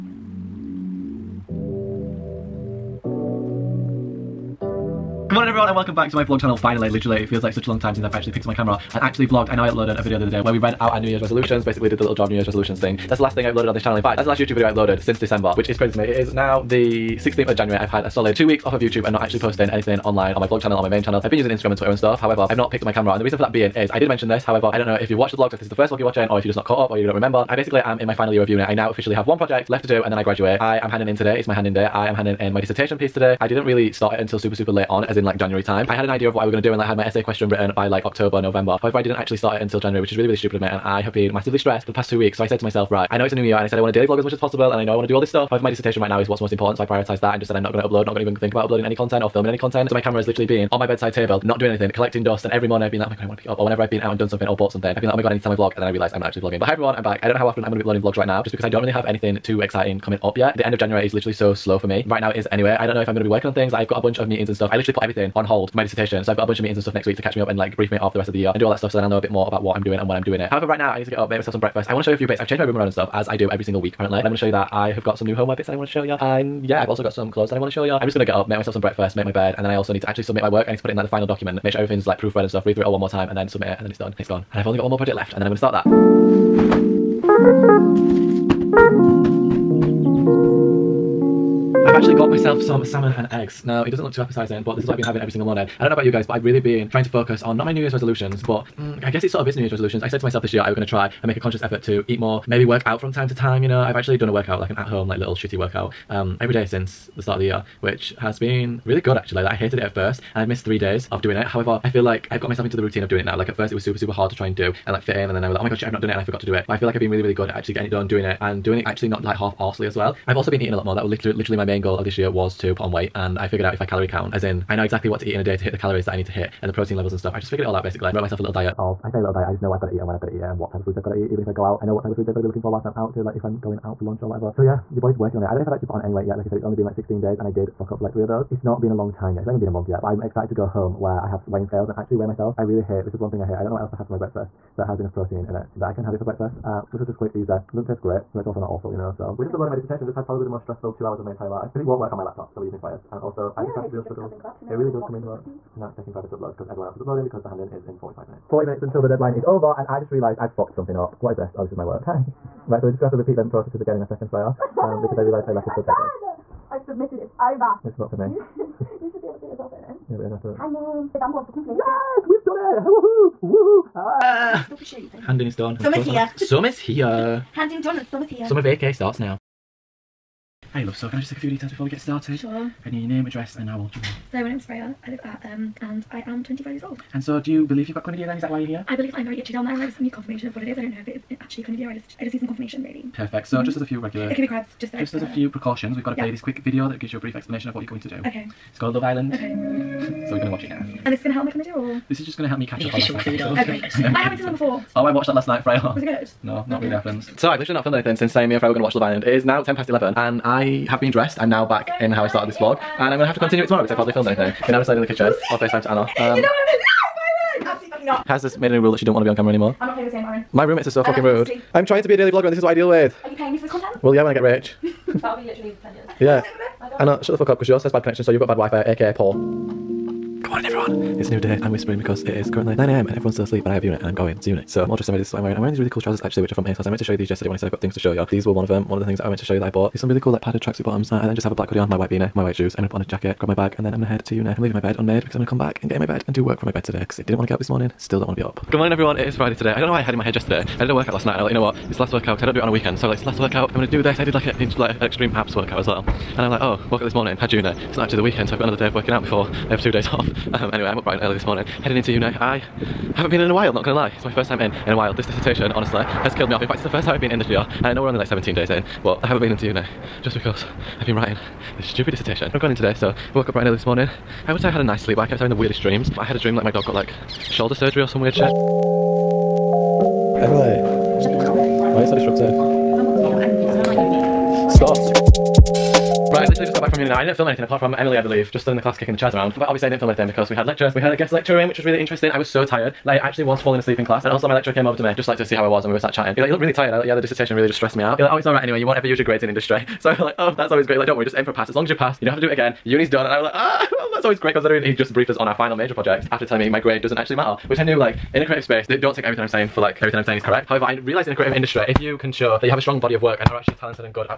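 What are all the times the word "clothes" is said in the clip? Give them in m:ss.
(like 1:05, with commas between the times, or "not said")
1:17.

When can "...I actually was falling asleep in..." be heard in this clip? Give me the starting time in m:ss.
4:53.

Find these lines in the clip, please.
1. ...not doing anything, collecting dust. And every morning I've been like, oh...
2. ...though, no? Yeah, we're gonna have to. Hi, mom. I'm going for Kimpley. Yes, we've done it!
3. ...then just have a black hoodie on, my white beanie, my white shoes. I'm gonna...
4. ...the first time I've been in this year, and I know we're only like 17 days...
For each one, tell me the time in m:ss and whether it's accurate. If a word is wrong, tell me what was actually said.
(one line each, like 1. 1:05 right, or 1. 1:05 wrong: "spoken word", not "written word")
1. 0:51 right
2. 2:49 right
3. 4:01 right
4. 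4:26 right.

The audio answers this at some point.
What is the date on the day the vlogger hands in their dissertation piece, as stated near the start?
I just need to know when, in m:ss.
0:17.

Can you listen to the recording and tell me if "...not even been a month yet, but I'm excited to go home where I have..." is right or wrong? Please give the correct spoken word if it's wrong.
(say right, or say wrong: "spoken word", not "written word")
right.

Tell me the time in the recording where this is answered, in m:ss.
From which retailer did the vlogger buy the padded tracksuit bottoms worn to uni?
3:56.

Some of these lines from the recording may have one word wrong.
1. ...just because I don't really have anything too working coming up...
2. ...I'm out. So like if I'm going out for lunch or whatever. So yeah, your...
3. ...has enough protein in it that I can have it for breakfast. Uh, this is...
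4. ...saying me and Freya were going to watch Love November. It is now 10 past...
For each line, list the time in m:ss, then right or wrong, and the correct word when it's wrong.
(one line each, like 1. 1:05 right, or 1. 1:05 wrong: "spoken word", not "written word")
1. 0:58 wrong: "exciting", not "working"
2. 2:12 right
3. 2:24 right
4. 3:28 wrong: "Island", not "November".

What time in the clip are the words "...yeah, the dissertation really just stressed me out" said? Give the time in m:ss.
4:57.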